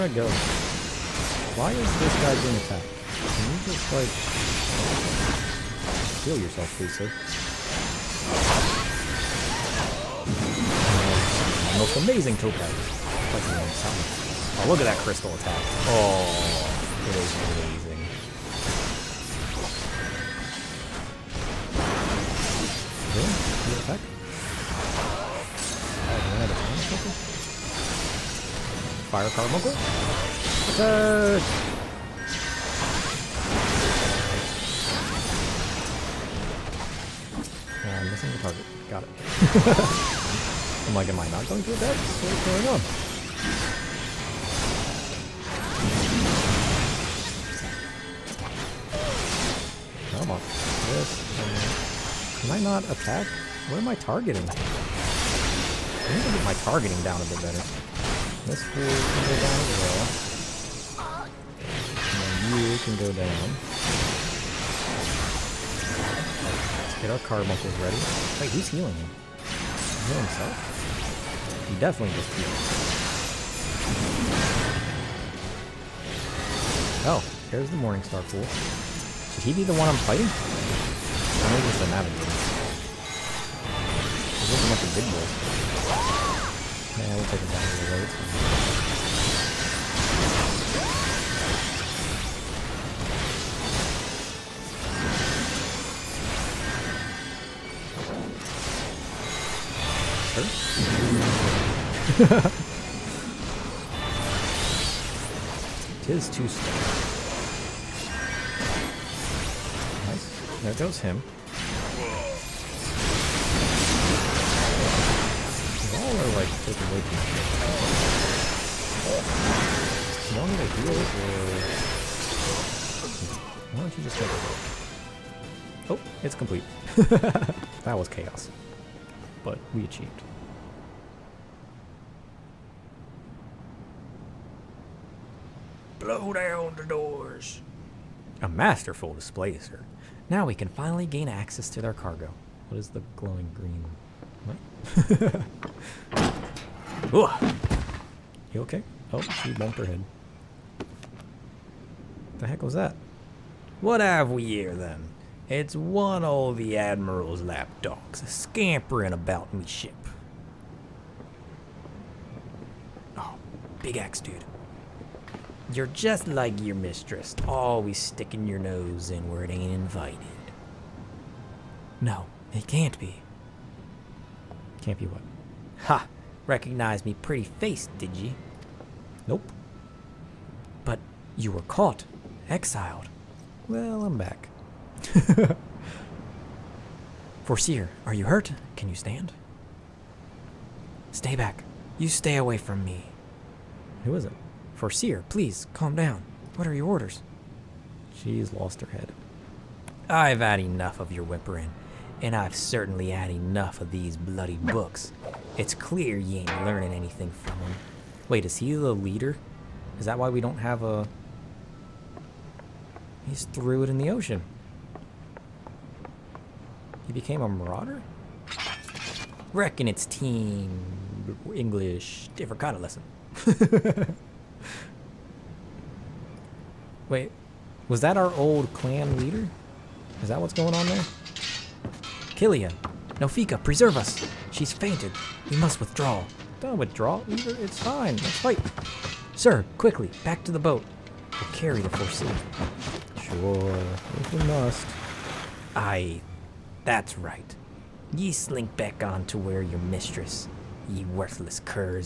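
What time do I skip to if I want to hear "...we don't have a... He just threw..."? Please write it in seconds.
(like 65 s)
210 s.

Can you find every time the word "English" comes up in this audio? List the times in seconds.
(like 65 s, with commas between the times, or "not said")
221 s.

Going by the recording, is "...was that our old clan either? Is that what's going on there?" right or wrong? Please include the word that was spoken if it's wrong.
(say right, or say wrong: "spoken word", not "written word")
wrong: "leader", not "either".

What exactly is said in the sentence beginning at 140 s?
Now we can finally gain access to their cargo.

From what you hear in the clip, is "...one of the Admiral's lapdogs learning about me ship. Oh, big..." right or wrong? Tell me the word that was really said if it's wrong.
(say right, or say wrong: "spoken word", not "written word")
wrong: "scampering", not "learning".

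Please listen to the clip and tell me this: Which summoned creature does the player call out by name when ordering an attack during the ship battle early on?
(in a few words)
Fire Carbuncle.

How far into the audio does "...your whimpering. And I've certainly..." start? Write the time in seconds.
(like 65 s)
201 s.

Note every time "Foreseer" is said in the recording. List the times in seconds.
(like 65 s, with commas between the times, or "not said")
187 s, 194 s.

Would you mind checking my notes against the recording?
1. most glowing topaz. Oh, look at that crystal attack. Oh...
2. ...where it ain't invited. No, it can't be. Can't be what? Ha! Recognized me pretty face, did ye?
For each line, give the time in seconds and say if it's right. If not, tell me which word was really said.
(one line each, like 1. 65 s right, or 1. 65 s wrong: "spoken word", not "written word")
1. 11 s wrong: "amazing", not "glowing"
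2. 169 s right.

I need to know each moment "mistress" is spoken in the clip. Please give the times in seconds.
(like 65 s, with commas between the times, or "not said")
166 s, 249 s.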